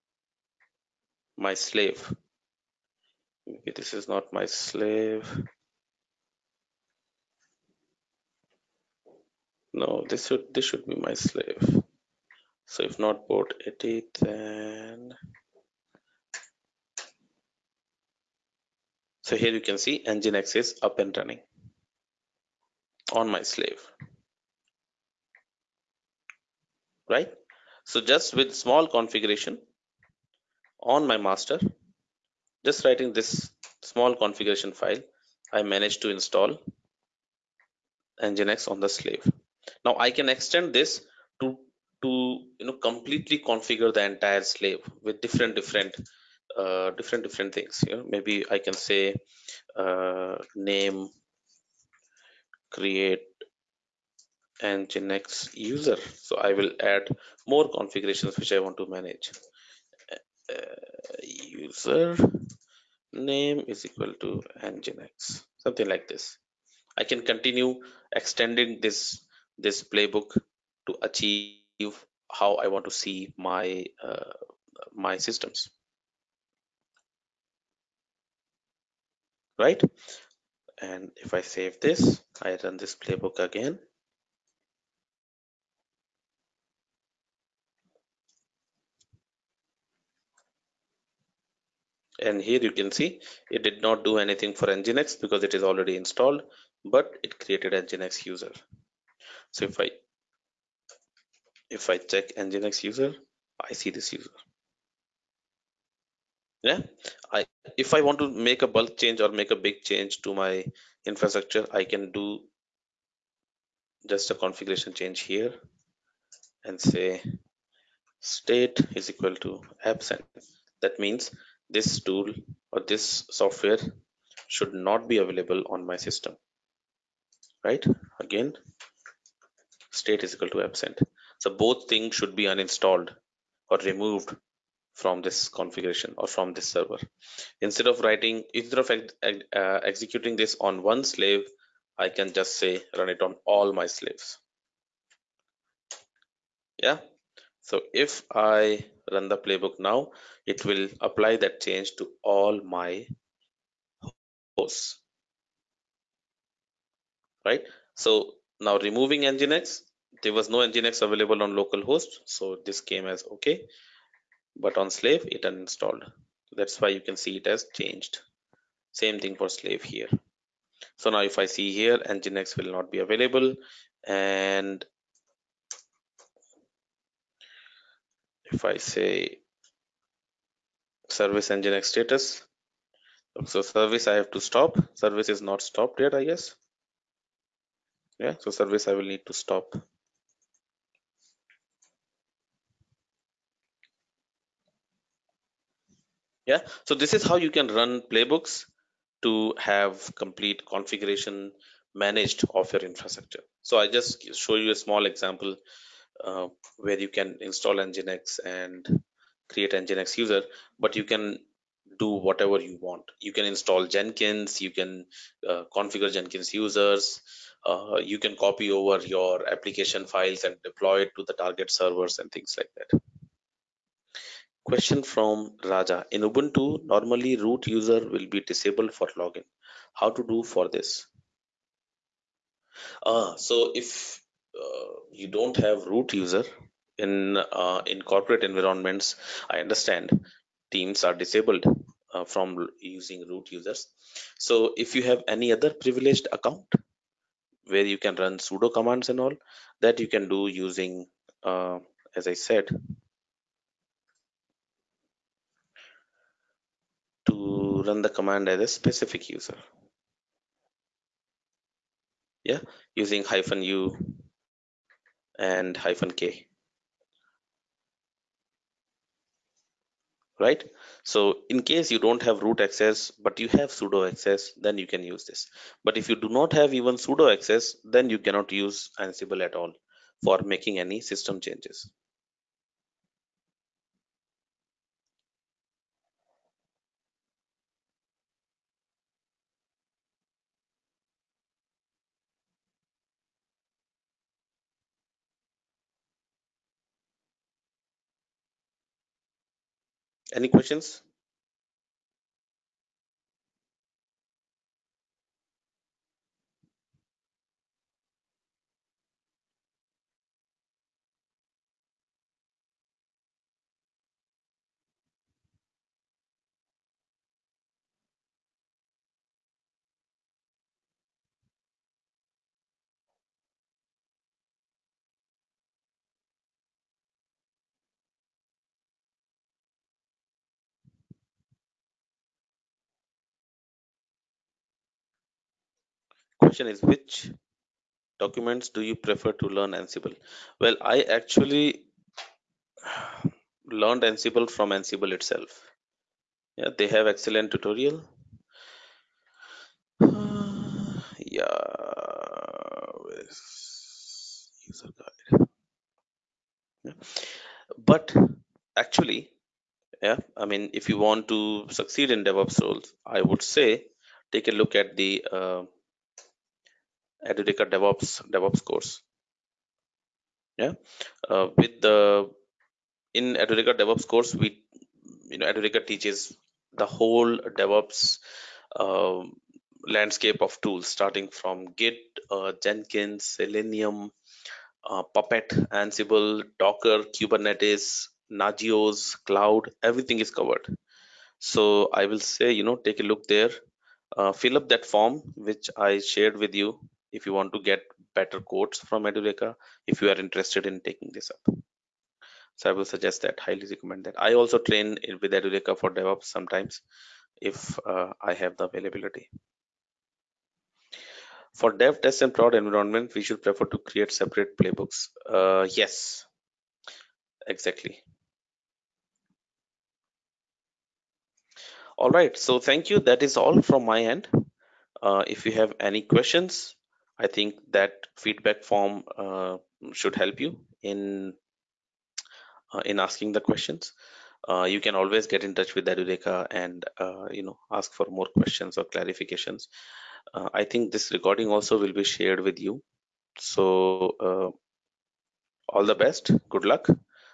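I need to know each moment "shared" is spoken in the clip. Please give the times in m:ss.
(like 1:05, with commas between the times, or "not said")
6:35, 7:22.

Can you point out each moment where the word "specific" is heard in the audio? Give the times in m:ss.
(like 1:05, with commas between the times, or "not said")
4:18.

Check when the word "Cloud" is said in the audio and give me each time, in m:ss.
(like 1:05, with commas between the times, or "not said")
6:29.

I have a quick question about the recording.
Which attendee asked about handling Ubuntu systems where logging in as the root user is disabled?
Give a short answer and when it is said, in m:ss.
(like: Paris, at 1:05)
Raja, at 3:45.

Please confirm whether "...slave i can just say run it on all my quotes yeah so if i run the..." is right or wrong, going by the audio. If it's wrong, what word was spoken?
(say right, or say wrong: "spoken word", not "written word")
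wrong: "slaves", not "quotes".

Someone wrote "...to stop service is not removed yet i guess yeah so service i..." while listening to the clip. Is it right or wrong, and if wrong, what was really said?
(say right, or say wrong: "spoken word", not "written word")
wrong: "stopped", not "removed".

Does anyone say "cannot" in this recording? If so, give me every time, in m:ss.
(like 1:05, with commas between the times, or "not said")
4:38.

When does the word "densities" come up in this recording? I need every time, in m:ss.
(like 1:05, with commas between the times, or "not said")
not said.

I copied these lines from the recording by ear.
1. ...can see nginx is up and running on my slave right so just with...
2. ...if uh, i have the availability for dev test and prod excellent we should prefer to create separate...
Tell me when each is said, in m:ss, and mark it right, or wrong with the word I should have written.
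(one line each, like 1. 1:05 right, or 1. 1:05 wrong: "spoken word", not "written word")
1. 0:19 right
2. 6:47 wrong: "environment", not "excellent".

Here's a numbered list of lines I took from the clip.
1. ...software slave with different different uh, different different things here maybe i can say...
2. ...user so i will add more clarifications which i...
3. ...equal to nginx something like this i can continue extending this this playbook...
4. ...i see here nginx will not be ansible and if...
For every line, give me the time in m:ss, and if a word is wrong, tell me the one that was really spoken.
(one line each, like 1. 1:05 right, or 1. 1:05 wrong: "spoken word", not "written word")
1. 0:44 wrong: "entire", not "software"
2. 0:55 wrong: "configurations", not "clarifications"
3. 1:03 right
4. 2:51 wrong: "available", not "ansible".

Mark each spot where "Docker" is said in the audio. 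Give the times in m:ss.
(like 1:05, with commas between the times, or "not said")
6:26.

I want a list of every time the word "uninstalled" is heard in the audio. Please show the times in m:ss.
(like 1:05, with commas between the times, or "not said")
2:12, 2:45.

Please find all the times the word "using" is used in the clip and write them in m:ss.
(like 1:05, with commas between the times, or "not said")
4:02, 4:10, 4:23.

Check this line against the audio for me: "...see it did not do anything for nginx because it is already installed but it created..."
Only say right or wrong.
right.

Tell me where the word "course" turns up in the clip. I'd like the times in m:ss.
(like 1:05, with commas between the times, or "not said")
6:08, 6:14.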